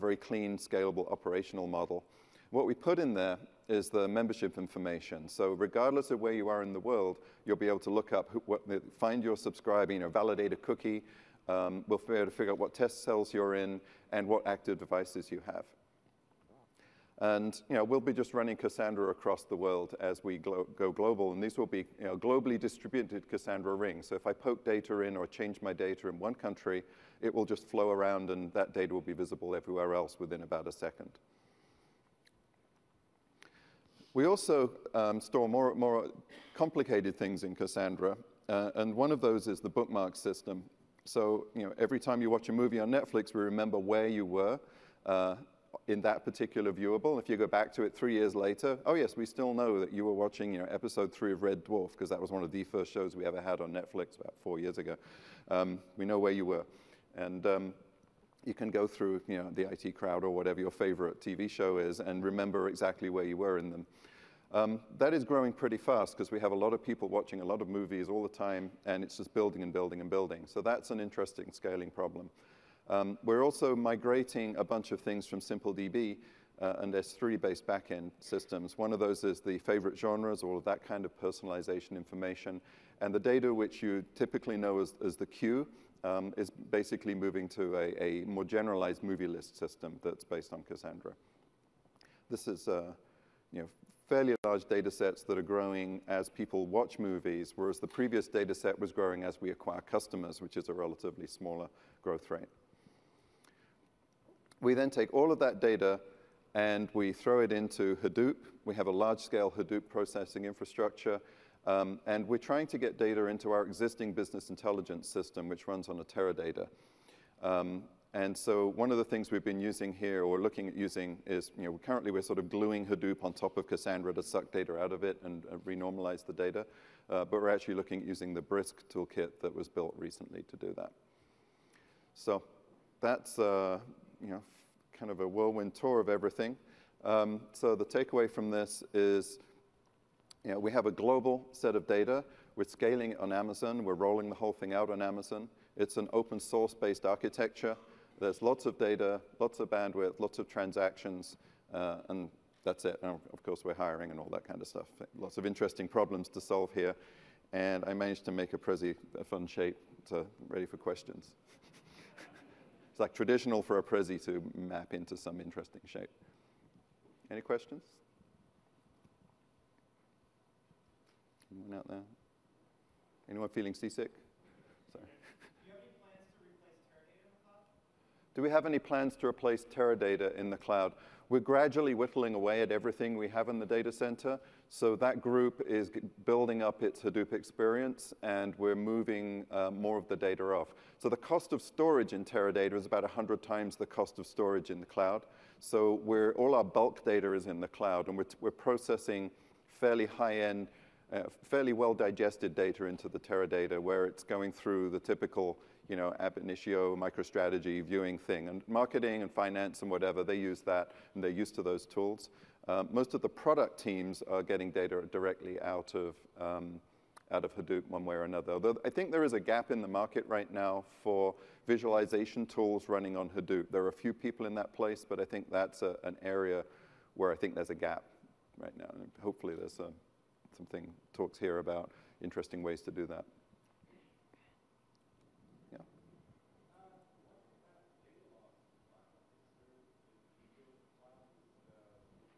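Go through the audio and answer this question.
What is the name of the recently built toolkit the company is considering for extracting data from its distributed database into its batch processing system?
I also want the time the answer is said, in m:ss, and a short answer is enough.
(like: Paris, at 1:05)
Brisk, at 2:08.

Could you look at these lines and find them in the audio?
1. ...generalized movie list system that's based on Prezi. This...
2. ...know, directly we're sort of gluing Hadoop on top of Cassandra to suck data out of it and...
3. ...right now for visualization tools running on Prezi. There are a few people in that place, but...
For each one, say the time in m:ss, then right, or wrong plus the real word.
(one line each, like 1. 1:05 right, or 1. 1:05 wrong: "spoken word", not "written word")
1. 1:28 wrong: "Cassandra", not "Prezi"
2. 2:01 wrong: "currently", not "directly"
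3. 3:40 wrong: "Hadoop", not "Prezi".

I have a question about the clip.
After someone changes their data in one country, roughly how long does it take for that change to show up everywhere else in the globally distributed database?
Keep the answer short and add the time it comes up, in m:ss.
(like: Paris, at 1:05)
about a second, at 0:30.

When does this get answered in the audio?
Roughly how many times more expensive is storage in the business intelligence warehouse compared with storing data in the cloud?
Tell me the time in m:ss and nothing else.
3:13.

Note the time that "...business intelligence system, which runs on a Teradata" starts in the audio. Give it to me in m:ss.
1:54.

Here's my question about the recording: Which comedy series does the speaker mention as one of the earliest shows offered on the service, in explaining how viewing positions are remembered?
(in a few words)
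Red Dwarf.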